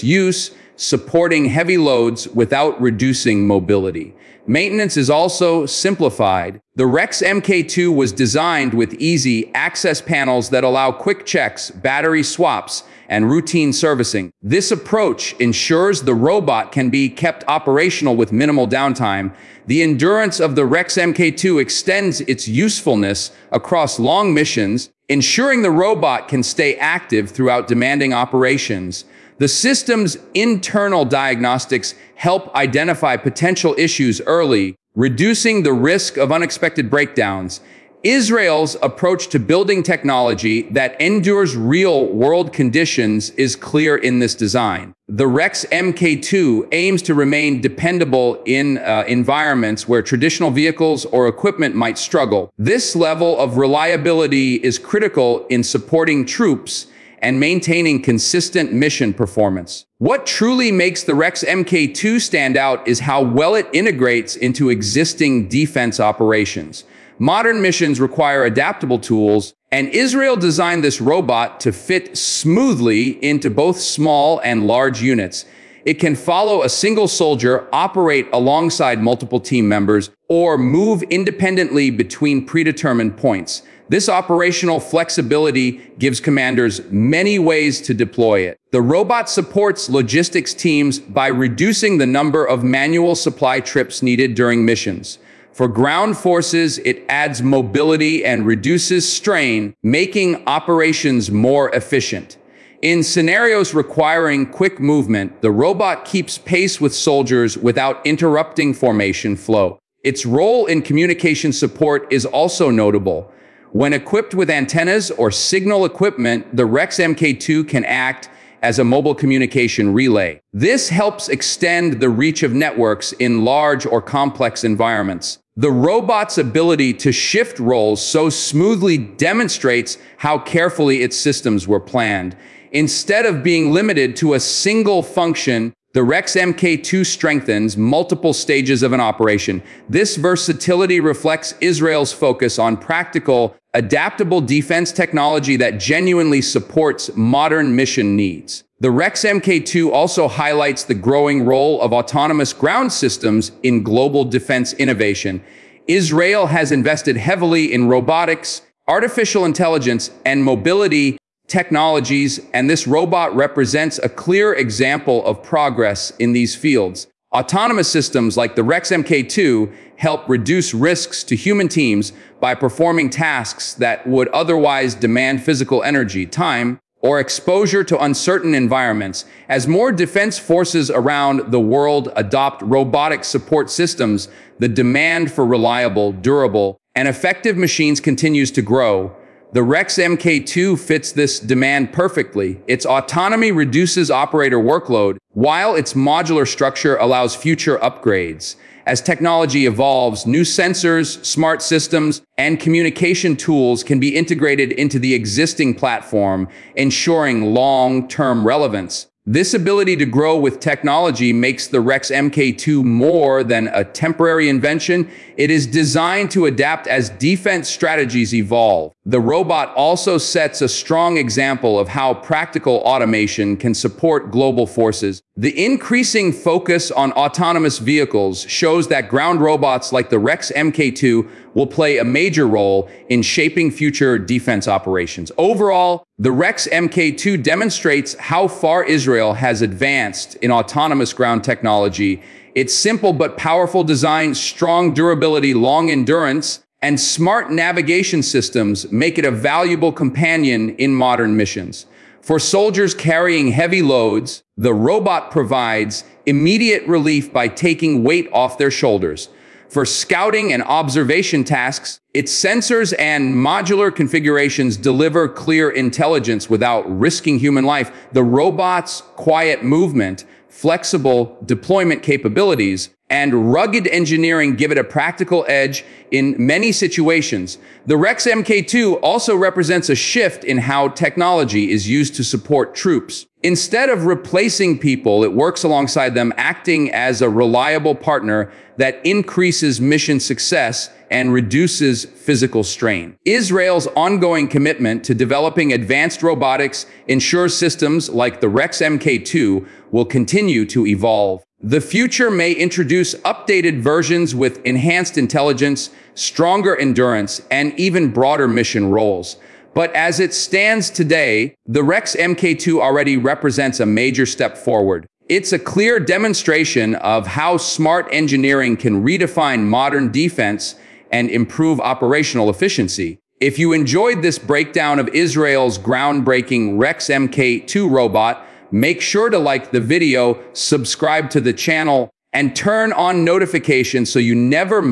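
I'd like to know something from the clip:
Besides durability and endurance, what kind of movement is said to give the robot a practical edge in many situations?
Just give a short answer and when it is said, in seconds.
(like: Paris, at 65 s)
Quiet movement, at 269 s.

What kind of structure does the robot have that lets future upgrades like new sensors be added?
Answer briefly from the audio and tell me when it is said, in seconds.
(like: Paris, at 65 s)
Modular structure, at 195 s.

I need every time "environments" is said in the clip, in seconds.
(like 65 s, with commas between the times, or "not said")
49 s, 124 s, 178 s.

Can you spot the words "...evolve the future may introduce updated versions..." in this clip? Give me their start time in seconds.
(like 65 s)
300 s.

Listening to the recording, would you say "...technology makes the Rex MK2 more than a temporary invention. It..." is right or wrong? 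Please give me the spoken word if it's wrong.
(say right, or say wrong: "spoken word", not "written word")
right.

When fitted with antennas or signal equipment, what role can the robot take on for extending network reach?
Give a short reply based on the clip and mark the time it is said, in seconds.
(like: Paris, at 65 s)
Mobile communication relay, at 118 s.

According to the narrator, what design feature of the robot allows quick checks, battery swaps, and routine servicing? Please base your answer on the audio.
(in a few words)
Easy access panels.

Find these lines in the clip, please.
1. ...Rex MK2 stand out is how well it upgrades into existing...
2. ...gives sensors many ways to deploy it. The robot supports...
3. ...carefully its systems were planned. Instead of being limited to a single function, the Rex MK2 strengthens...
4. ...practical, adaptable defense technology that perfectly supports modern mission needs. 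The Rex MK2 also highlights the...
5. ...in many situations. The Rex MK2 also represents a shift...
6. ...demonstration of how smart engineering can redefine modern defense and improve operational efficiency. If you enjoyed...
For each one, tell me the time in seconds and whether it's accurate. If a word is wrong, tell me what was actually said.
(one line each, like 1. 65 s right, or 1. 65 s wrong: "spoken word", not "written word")
1. 61 s wrong: "integrates", not "upgrades"
2. 86 s wrong: "commanders", not "sensors"
3. 130 s right
4. 142 s wrong: "genuinely", not "perfectly"
5. 276 s right
6. 315 s right.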